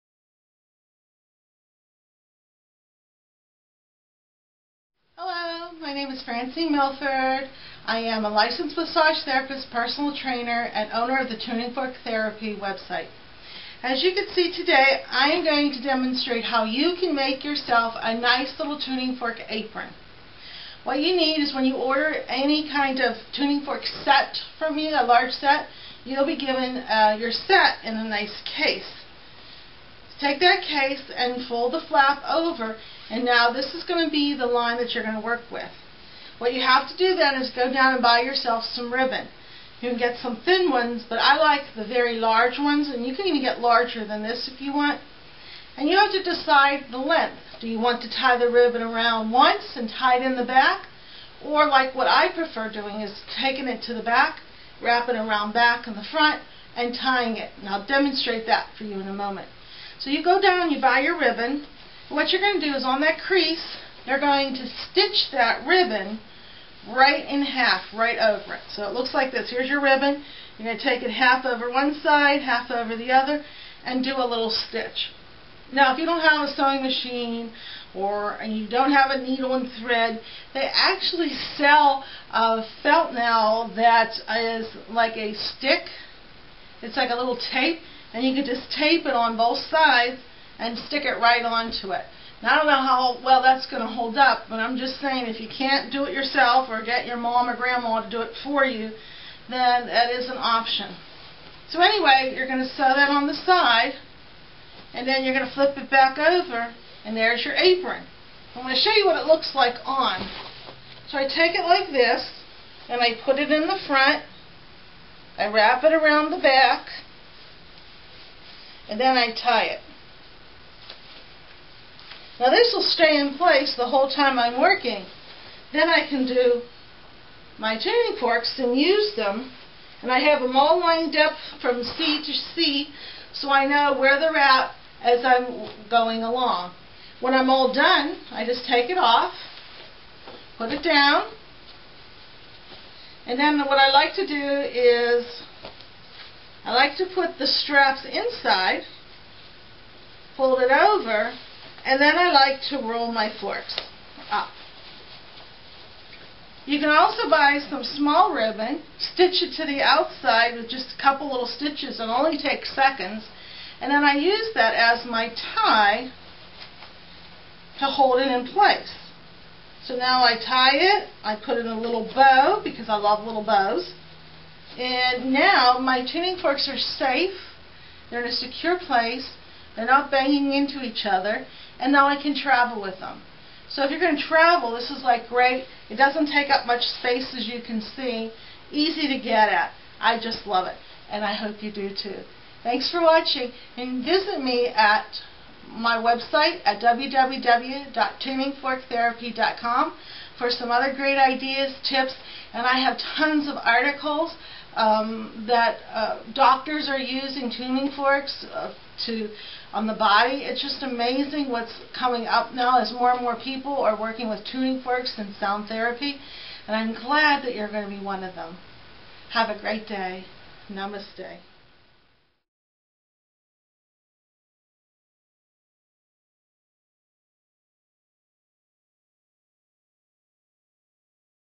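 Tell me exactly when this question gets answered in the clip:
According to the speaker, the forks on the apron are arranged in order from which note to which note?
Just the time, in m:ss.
2:11.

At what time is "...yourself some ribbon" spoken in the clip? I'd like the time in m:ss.
0:38.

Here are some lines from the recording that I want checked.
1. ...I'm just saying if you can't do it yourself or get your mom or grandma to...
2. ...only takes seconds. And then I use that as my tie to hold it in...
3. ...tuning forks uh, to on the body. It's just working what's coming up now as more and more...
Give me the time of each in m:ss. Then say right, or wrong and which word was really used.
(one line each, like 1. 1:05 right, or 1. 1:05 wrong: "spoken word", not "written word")
1. 1:34 right
2. 2:42 right
3. 3:27 wrong: "amazing", not "working".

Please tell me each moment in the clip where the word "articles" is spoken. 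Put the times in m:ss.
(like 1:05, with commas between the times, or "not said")
3:23.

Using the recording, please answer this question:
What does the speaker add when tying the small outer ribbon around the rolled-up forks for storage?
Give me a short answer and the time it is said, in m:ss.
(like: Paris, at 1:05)
A little bow, at 2:51.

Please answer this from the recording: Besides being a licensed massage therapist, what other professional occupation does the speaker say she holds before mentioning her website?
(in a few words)
Personal trainer.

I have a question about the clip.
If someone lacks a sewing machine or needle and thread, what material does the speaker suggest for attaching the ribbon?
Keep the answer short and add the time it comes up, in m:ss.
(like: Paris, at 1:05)
Felt, at 1:22.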